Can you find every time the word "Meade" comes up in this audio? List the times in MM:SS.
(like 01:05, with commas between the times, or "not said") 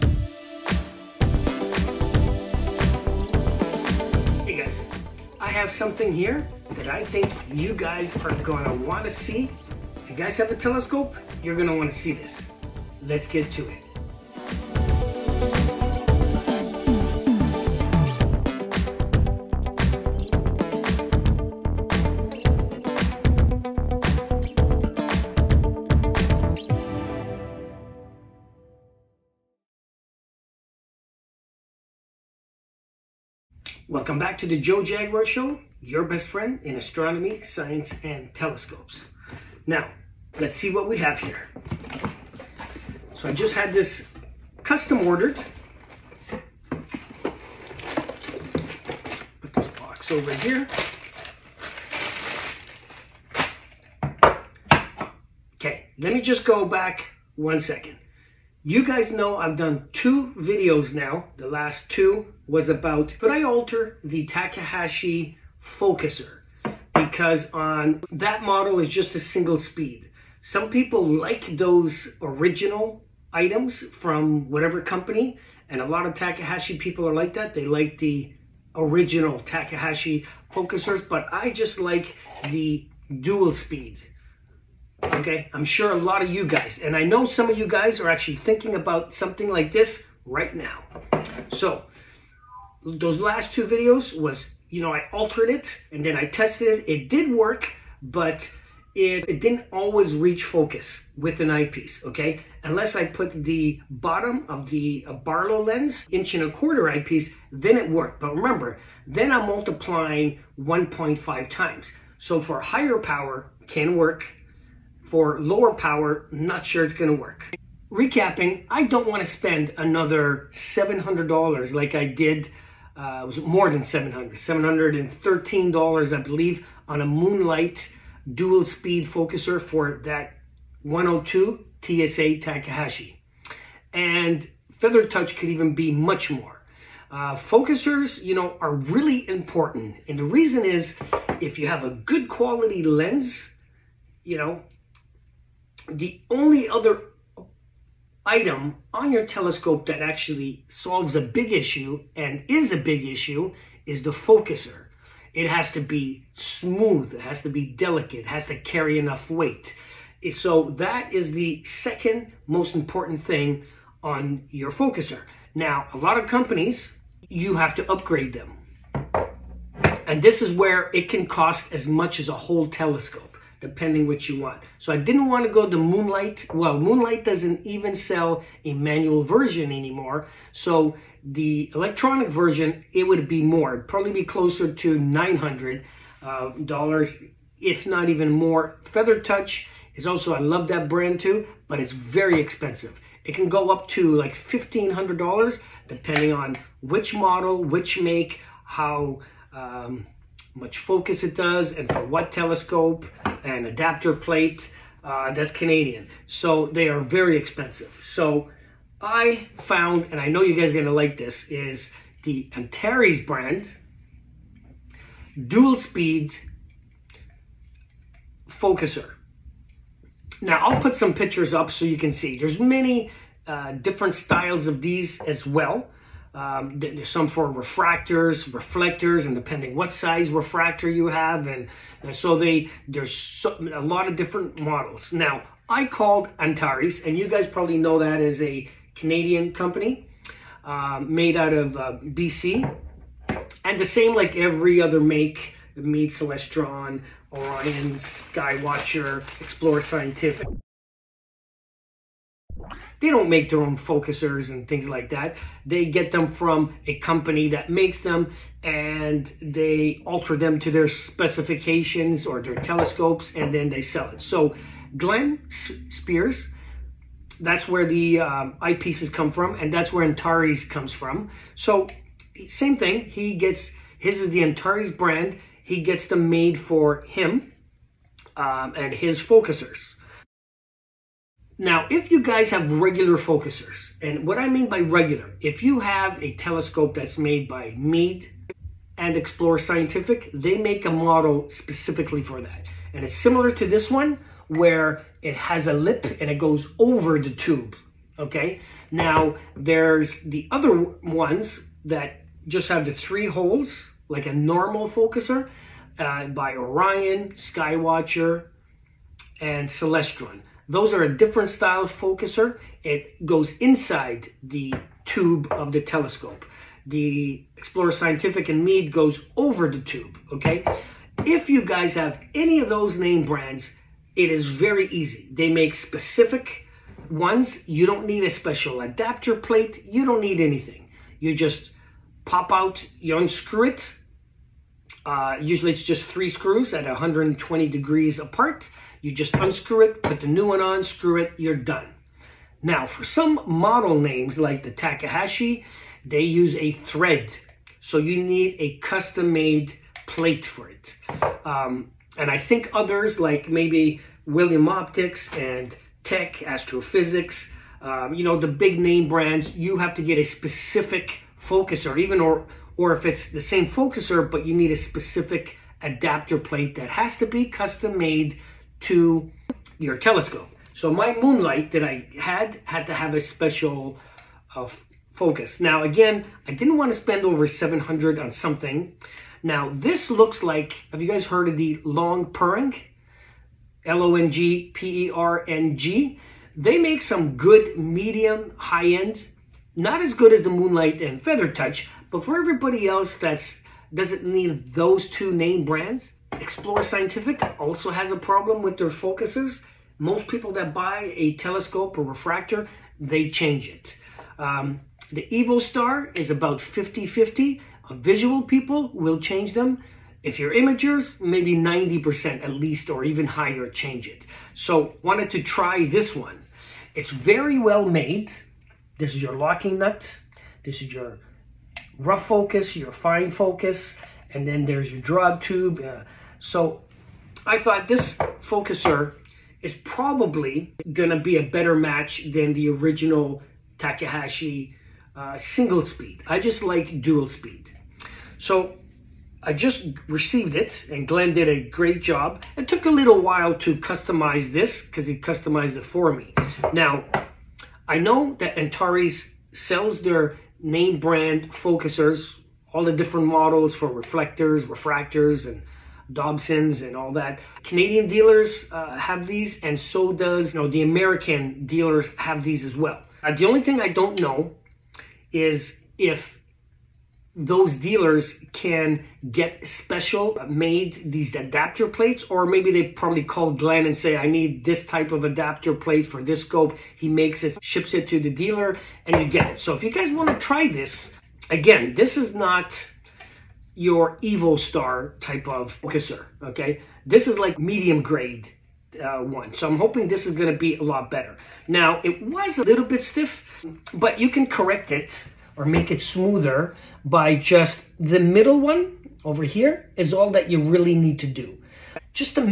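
04:47, 05:18.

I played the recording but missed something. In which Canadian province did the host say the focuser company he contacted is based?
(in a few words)
BC.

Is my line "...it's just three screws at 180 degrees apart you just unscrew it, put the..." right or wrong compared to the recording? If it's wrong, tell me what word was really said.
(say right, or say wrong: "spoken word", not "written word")
wrong: "120", not "180".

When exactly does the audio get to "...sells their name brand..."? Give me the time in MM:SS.
07:29.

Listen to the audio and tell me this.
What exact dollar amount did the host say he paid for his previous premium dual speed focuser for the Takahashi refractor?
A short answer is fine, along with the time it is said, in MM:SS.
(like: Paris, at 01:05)
$713, at 02:04.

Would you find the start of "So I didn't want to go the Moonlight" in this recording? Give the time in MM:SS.
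02:54.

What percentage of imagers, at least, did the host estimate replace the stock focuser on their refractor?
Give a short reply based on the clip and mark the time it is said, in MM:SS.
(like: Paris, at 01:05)
90%, at 06:51.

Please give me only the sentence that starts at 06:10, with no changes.
So my moonlight that I had had to have a special uh, focus.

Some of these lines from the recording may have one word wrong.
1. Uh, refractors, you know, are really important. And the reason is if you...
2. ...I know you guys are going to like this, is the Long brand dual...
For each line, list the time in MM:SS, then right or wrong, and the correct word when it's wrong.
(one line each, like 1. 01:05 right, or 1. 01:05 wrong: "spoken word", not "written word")
1. 02:17 wrong: "focusers", not "refractors"
2. 03:30 wrong: "Antares", not "Long".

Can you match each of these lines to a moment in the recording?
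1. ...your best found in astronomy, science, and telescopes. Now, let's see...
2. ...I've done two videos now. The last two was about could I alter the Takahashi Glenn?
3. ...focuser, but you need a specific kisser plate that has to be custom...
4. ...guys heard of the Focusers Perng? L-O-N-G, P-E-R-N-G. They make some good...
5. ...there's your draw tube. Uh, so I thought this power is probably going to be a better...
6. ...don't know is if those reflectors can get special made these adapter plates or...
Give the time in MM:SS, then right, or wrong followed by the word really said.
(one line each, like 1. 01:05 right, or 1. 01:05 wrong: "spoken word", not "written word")
1. 00:35 wrong: "friend", not "found"
2. 00:59 wrong: "Focuser", not "Glenn"
3. 06:03 wrong: "adapter", not "kisser"
4. 06:21 wrong: "Long", not "Focusers"
5. 07:04 wrong: "focuser", not "power"
6. 07:43 wrong: "dealers", not "reflectors".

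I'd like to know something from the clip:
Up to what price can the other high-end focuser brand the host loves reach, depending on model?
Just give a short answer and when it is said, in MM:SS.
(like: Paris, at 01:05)
$1,500, at 03:14.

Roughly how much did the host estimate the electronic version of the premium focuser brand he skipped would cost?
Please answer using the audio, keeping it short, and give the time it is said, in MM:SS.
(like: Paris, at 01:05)
$900, at 03:04.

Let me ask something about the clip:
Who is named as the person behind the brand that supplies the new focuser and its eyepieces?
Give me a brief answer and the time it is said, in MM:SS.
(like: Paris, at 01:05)
Glenn Spears, at 04:24.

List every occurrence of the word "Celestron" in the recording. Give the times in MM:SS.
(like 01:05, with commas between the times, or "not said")
04:06, 05:09.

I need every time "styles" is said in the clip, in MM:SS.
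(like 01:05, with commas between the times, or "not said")
03:44, 05:11.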